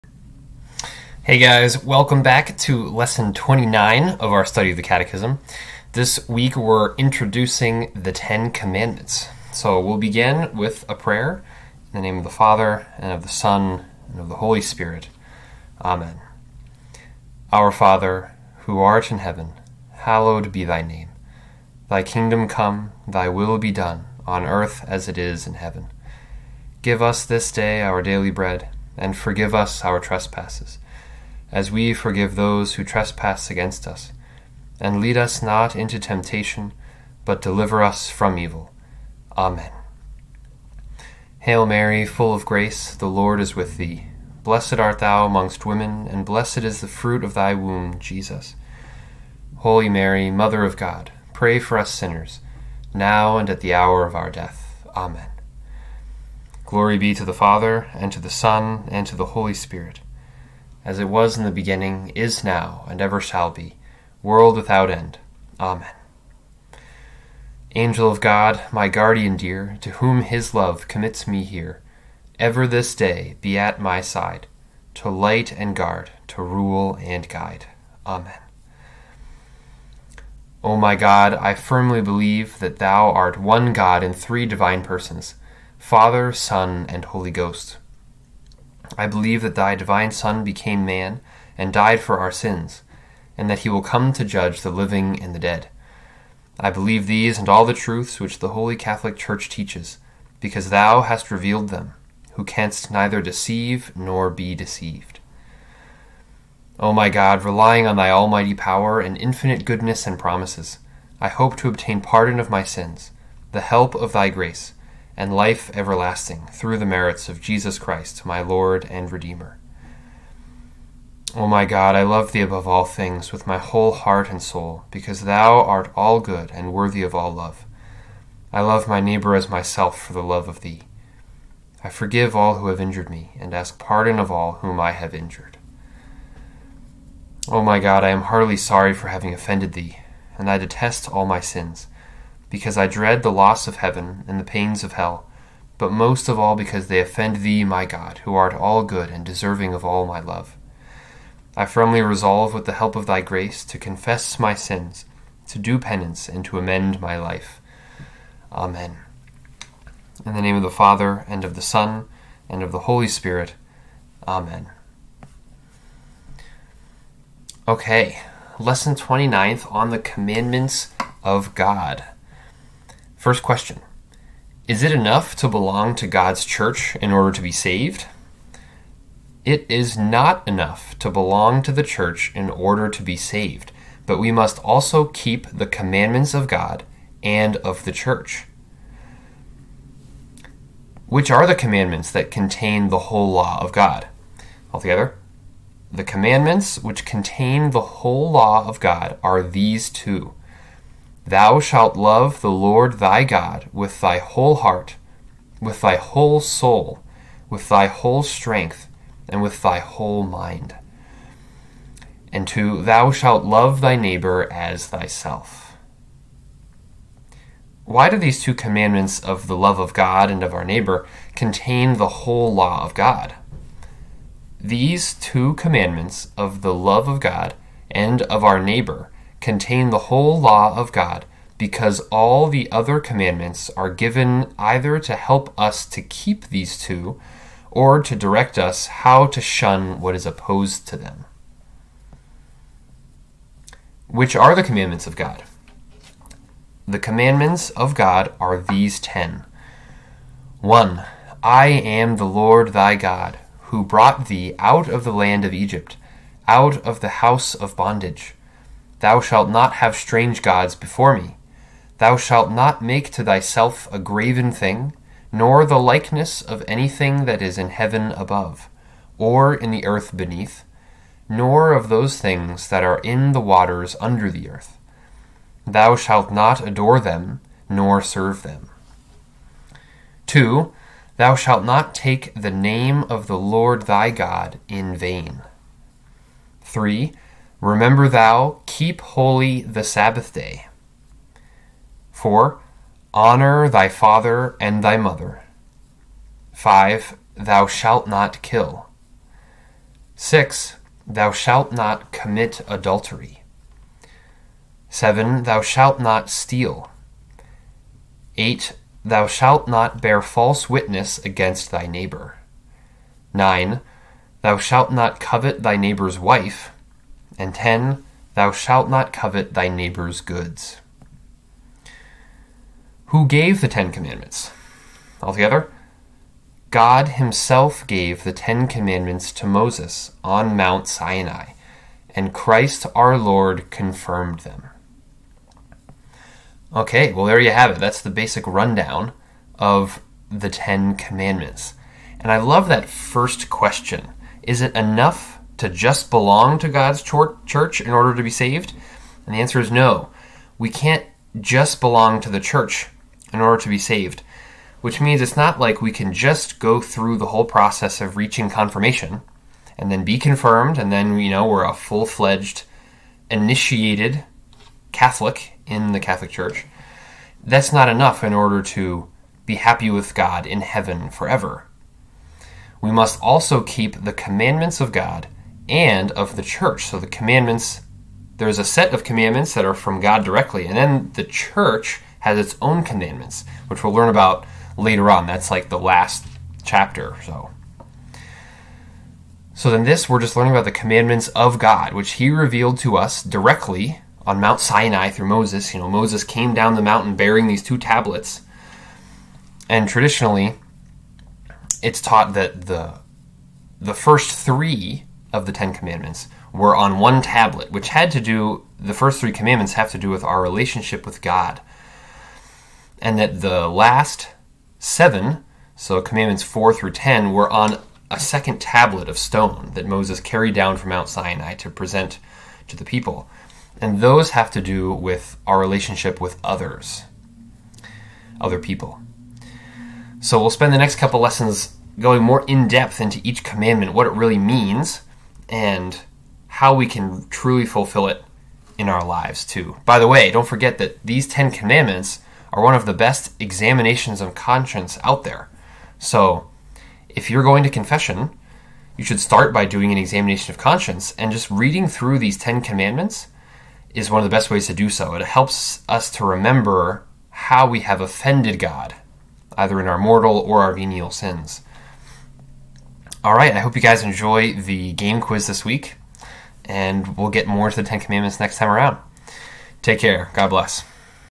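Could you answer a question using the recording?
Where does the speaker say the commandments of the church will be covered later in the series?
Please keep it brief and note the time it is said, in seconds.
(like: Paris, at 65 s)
the last chapter, at 385 s.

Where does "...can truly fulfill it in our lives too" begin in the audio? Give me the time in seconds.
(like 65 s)
436 s.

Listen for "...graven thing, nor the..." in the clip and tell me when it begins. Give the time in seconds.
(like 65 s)
263 s.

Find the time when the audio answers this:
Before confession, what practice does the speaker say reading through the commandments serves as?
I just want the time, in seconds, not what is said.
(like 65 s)
449 s.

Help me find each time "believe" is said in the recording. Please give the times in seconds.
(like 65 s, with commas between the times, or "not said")
82 s, 89 s, 96 s.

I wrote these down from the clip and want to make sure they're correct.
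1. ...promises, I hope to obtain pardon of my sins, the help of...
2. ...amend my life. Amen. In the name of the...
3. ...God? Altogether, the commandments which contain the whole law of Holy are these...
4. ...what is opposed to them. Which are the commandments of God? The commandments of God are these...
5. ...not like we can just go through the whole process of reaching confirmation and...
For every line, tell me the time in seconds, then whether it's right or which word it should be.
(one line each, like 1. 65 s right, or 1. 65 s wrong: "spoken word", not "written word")
1. 110 s right
2. 156 s right
3. 193 s wrong: "God", not "Holy"
4. 239 s right
5. 355 s right.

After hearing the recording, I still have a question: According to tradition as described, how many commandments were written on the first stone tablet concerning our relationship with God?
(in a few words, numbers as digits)
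3.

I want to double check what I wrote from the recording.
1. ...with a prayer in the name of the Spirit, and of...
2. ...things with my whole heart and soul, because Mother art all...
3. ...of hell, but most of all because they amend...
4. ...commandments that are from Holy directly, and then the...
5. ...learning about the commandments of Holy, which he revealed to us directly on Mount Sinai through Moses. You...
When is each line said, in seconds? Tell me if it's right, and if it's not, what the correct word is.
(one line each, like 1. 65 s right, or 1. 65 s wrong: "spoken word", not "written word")
1. 10 s wrong: "Father", not "Spirit"
2. 122 s wrong: "Thou", not "Mother"
3. 144 s wrong: "offend", not "amend"
4. 379 s wrong: "God", not "Holy"
5. 390 s wrong: "God", not "Holy".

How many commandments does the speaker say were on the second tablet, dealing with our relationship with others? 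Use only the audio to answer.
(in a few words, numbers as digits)
7.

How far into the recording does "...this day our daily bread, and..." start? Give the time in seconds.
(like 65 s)
27 s.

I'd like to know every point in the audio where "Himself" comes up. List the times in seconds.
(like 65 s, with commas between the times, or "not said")
327 s.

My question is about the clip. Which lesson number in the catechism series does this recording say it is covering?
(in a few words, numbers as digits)
29.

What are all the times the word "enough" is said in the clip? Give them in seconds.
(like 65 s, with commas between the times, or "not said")
174 s, 180 s, 344 s, 367 s.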